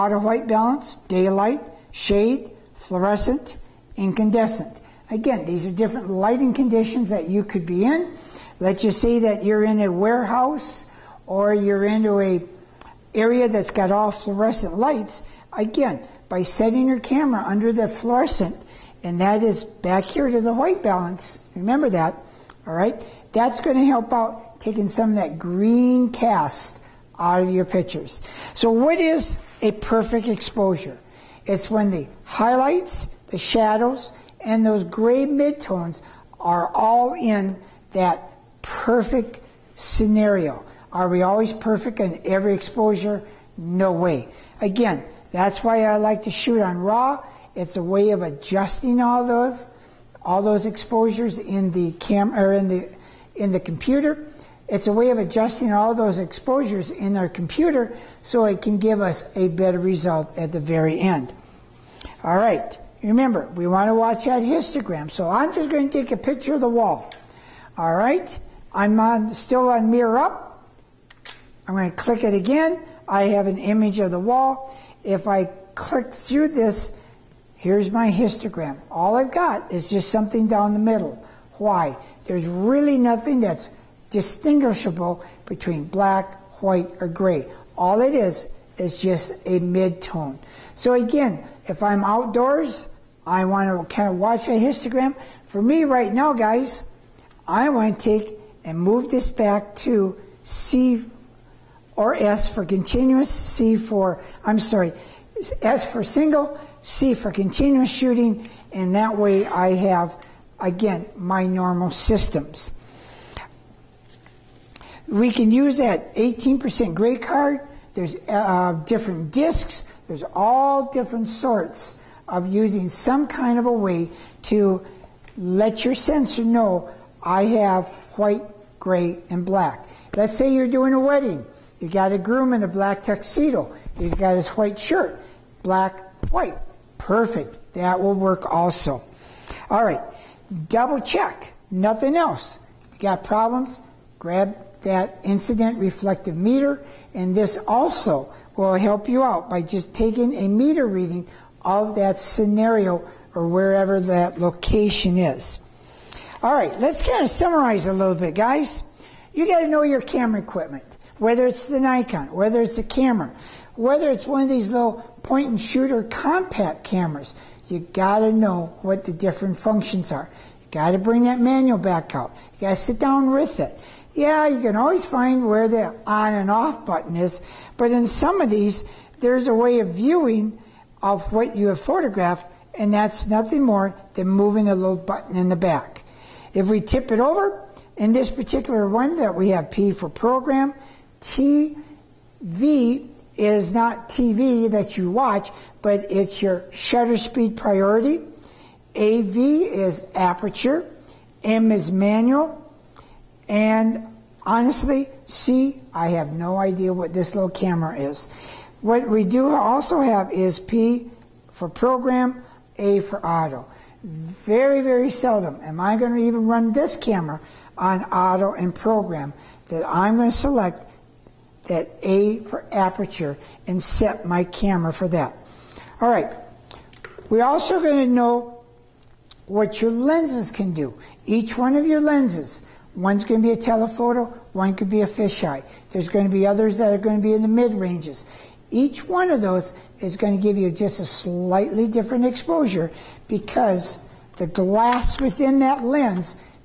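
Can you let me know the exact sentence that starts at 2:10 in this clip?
Let's say you're doing a wedding.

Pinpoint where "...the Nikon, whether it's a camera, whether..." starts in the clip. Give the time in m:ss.
2:41.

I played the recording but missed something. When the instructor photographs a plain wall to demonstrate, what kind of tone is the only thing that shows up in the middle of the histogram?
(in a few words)
mid-tone.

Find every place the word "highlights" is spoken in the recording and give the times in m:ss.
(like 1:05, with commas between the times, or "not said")
0:32.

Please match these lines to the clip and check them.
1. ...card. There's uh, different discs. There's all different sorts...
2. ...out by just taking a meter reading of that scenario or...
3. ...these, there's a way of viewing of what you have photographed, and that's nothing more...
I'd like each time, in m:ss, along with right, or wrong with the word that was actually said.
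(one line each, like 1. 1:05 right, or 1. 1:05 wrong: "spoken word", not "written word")
1. 1:57 right
2. 2:29 right
3. 2:58 right.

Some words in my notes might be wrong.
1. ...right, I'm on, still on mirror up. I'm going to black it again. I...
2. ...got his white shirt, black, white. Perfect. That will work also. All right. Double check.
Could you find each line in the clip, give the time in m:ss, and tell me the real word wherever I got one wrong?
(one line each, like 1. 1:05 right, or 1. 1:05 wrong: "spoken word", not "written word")
1. 1:07 wrong: "click", not "black"
2. 2:14 right.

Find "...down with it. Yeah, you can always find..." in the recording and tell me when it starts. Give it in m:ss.
2:52.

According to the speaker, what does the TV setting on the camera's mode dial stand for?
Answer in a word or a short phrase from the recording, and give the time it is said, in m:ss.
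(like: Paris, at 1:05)
shutter speed priority, at 3:16.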